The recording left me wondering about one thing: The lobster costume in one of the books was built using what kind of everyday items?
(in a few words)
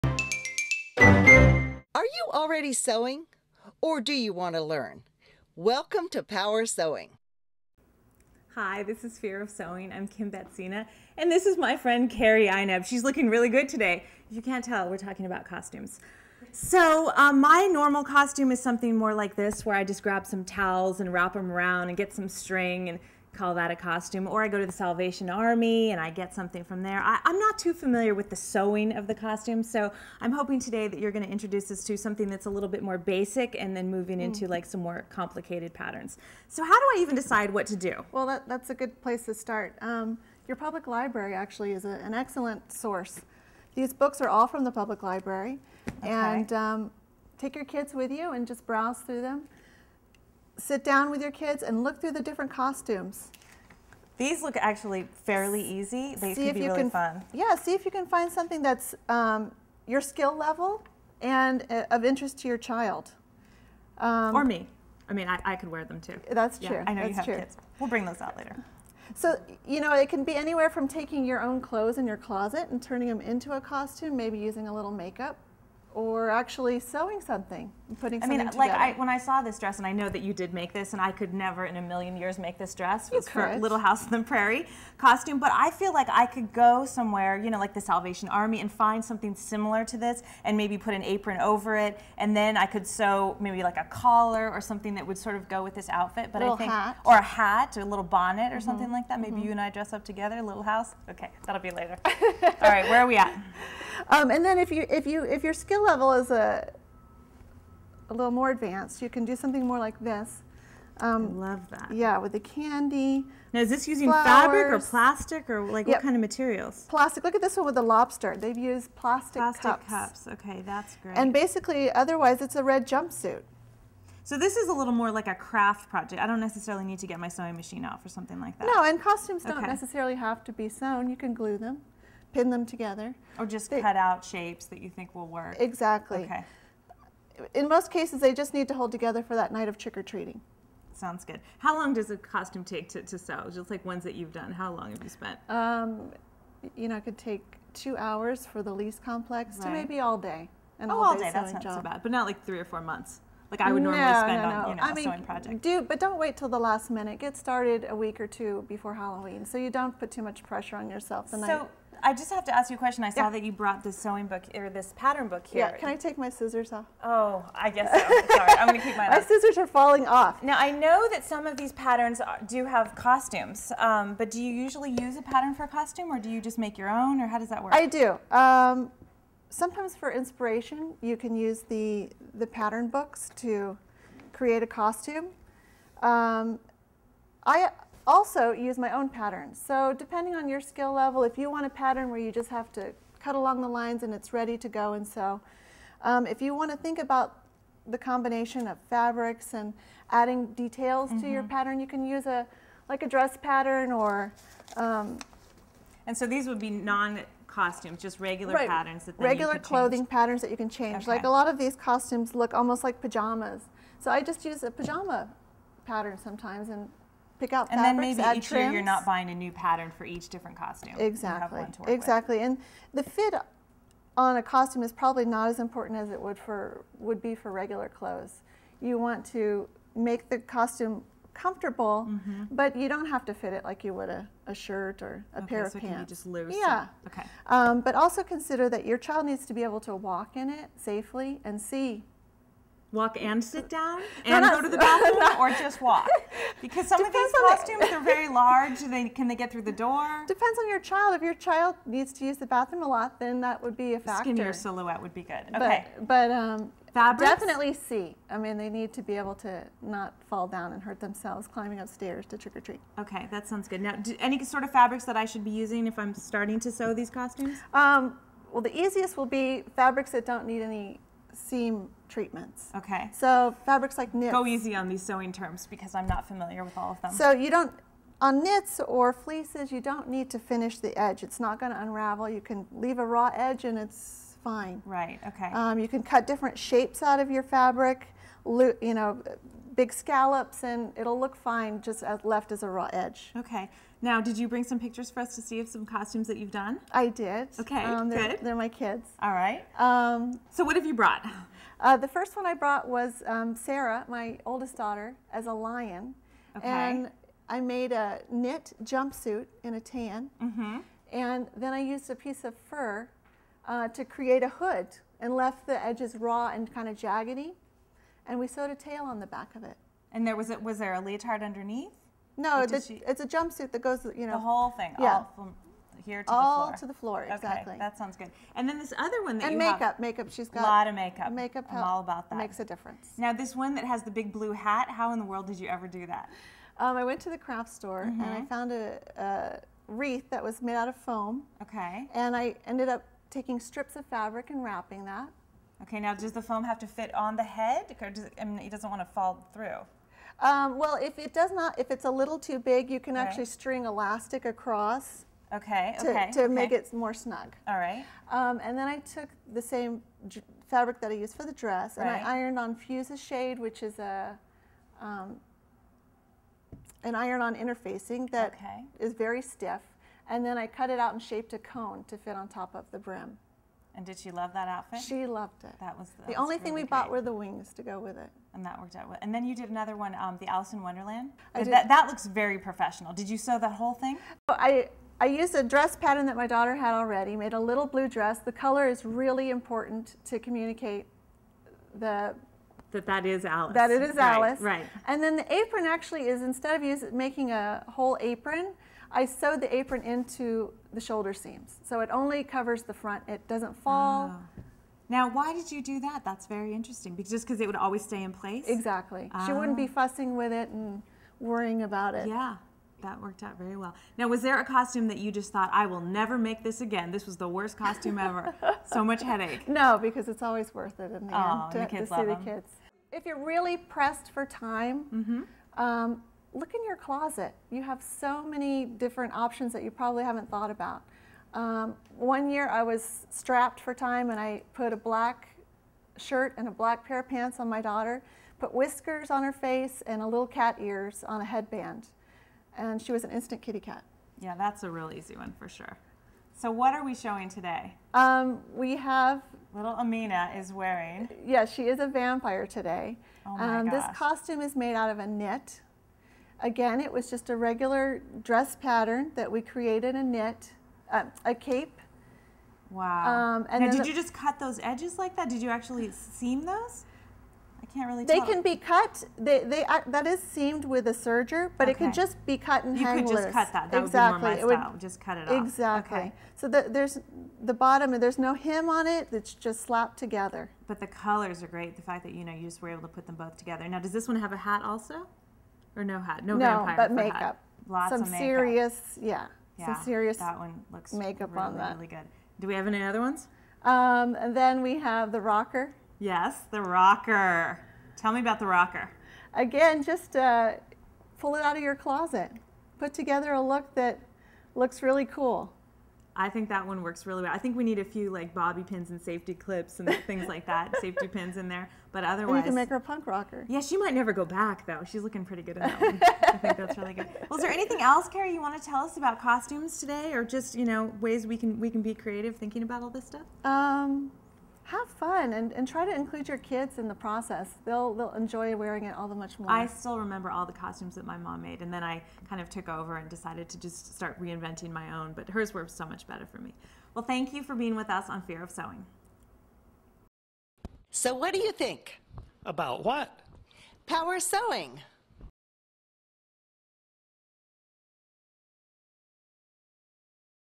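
Plastic cups.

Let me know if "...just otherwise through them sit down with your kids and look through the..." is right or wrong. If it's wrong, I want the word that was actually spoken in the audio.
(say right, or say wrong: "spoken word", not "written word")
wrong: "browse", not "otherwise".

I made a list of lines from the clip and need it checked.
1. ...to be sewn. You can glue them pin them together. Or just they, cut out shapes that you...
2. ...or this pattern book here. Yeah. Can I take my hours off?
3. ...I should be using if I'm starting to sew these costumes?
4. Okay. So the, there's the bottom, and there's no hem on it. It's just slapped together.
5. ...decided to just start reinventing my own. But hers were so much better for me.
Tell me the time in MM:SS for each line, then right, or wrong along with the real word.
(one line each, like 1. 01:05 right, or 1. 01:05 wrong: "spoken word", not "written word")
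1. 02:10 right
2. 02:44 wrong: "scissors", not "hours"
3. 04:25 right
4. 07:56 right
5. 08:53 right.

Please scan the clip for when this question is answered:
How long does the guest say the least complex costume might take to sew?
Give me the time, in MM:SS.
02:27.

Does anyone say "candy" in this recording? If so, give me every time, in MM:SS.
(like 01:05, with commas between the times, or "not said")
01:52.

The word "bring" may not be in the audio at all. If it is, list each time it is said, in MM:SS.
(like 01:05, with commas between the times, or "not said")
01:07, 04:54.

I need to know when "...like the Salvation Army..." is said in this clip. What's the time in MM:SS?
01:27.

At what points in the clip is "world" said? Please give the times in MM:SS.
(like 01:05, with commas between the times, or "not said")
05:35.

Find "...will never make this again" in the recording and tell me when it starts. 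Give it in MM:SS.
06:55.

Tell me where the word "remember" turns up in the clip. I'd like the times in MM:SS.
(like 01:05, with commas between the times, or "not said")
08:50.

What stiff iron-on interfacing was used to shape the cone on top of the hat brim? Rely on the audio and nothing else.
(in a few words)
Fuse's shade.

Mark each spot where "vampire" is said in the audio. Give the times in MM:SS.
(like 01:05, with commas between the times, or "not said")
07:32, 08:06.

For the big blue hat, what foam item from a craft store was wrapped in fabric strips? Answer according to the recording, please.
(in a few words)
A wreath.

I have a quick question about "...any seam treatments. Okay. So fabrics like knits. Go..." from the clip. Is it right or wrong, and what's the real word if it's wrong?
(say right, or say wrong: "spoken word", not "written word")
right.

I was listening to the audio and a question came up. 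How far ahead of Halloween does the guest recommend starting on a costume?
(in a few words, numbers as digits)
A week or two.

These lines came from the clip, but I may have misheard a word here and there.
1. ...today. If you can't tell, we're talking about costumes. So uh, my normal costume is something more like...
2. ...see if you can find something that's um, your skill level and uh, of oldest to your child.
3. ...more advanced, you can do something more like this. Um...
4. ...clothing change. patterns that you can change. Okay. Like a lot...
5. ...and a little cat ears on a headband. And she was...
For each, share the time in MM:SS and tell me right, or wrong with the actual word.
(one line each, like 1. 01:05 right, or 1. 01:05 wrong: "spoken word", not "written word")
1. 00:13 right
2. 00:57 wrong: "interest", not "oldest"
3. 01:48 right
4. 03:29 right
5. 07:20 right.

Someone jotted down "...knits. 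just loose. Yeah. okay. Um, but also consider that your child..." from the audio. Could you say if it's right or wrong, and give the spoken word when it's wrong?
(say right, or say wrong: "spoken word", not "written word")
wrong: "pants", not "knits".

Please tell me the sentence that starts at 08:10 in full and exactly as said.
That one looks makeup really, on that.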